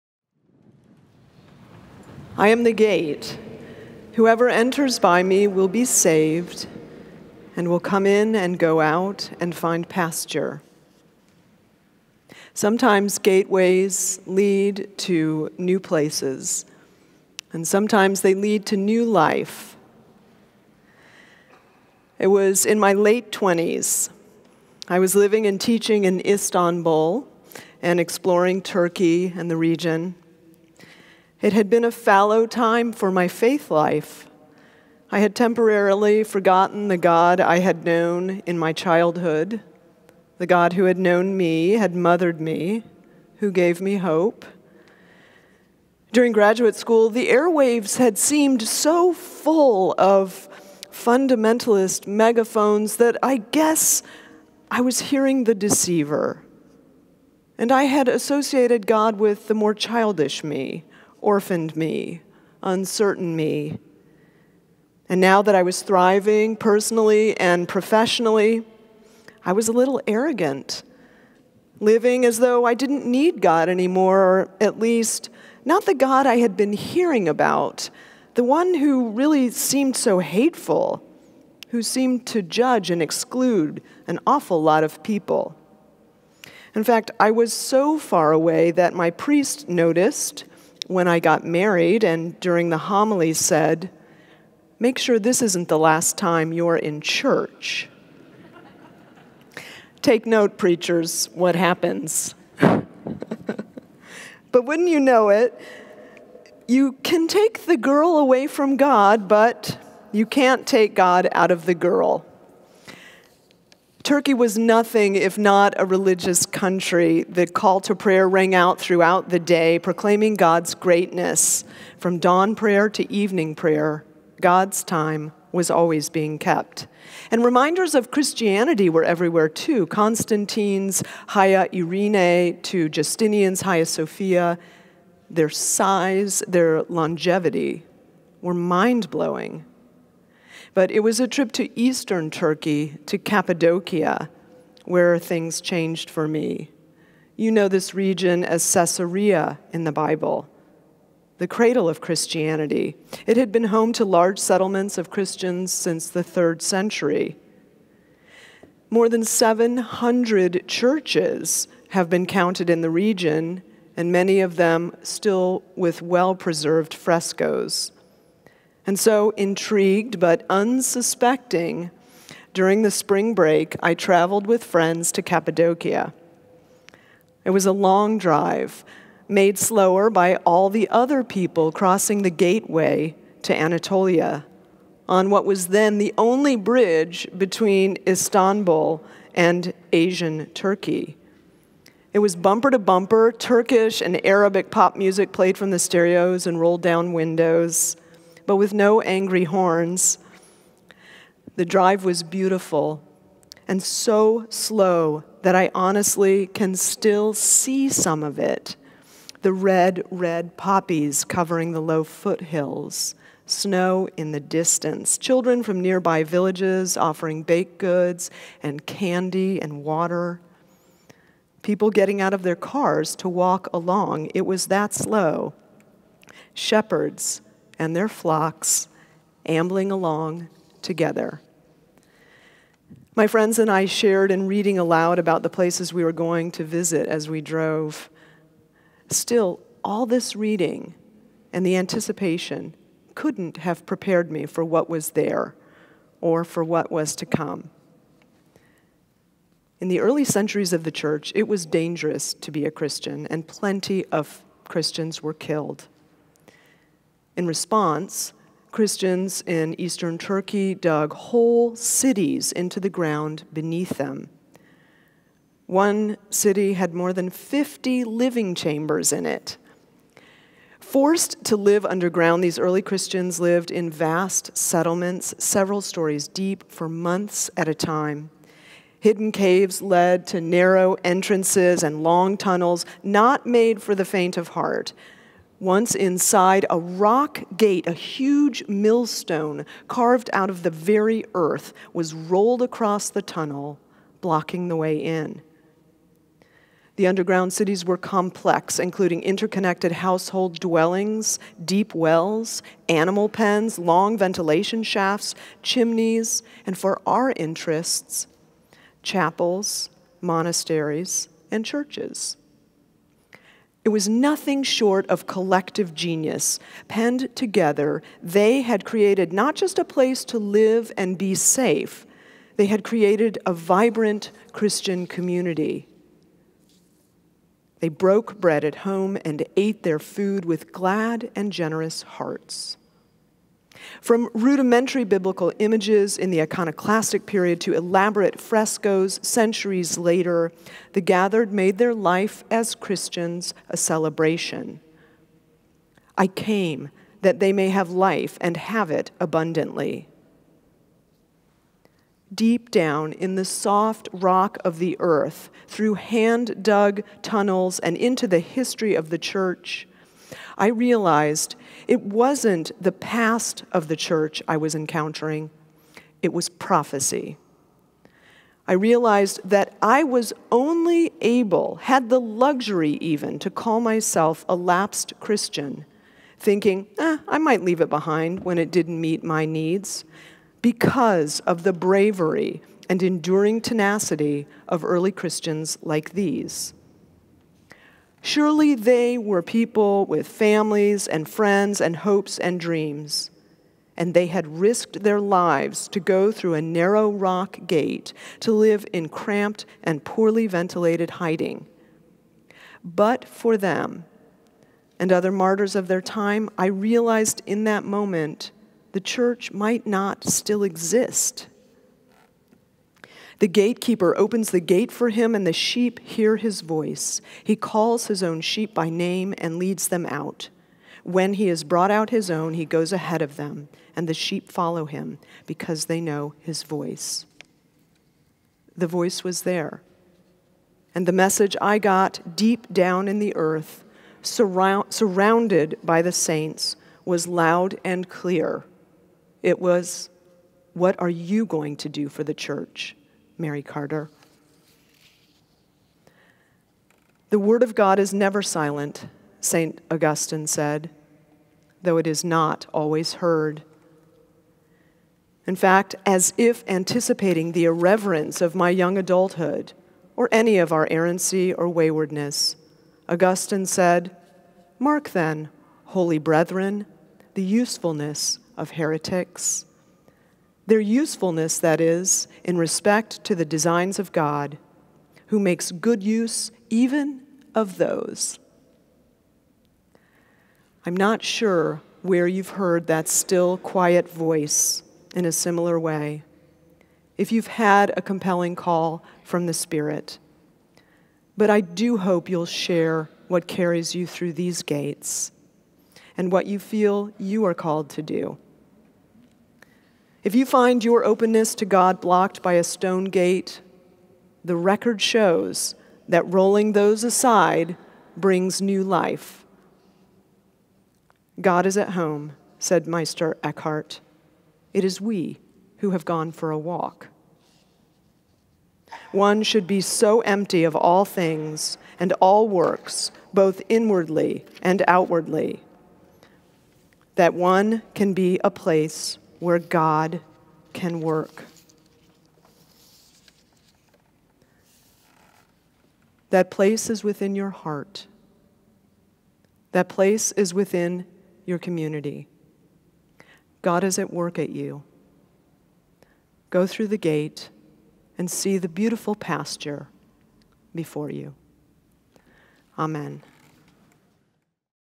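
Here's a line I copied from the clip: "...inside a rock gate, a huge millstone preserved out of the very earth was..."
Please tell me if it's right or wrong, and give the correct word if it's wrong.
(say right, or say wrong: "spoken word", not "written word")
wrong: "carved", not "preserved".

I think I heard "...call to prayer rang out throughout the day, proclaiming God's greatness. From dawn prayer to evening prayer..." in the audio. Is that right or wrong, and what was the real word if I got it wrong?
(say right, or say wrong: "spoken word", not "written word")
right.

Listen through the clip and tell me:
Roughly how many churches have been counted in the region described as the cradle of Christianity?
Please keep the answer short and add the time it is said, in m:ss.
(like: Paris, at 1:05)
More than 700, at 2:38.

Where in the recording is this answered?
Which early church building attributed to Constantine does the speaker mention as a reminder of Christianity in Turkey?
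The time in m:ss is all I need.
2:11.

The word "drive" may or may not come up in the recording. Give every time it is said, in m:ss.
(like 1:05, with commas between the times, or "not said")
2:58, 3:21.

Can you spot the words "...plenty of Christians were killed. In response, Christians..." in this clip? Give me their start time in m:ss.
4:13.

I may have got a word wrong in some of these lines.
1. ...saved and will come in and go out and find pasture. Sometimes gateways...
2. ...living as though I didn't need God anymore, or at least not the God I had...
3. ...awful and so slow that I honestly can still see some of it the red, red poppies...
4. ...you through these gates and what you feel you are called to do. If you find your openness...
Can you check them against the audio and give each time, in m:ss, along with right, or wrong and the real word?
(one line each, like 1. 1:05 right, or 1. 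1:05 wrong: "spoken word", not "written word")
1. 0:05 right
2. 1:11 right
3. 3:22 wrong: "beautiful", not "awful"
4. 8:13 right.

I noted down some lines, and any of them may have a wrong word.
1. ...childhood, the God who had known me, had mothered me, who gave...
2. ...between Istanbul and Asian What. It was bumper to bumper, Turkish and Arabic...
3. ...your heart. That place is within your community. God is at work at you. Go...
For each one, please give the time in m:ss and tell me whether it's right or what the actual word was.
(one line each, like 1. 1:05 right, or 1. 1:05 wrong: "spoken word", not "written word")
1. 0:38 right
2. 3:07 wrong: "Turkey", not "What"
3. 8:57 right.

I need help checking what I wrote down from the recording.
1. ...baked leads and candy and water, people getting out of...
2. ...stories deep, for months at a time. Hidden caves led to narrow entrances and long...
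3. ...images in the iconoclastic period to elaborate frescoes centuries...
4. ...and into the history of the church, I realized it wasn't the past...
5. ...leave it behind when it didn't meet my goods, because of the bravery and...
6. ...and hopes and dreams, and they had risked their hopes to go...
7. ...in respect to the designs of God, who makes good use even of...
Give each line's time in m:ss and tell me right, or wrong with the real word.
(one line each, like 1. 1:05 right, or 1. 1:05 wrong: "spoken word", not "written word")
1. 3:37 wrong: "goods", not "leads"
2. 4:35 right
3. 5:35 right
4. 5:57 right
5. 6:17 wrong: "needs", not "goods"
6. 6:31 wrong: "lives", not "hopes"
7. 7:52 right.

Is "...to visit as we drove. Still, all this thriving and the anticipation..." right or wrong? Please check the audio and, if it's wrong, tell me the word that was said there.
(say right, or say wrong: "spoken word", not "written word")
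wrong: "reading", not "thriving".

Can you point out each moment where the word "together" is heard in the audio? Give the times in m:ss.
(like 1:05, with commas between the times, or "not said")
3:50, 5:17.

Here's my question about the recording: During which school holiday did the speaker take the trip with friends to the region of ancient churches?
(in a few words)
Spring break.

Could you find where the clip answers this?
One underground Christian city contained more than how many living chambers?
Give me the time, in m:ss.
4:27.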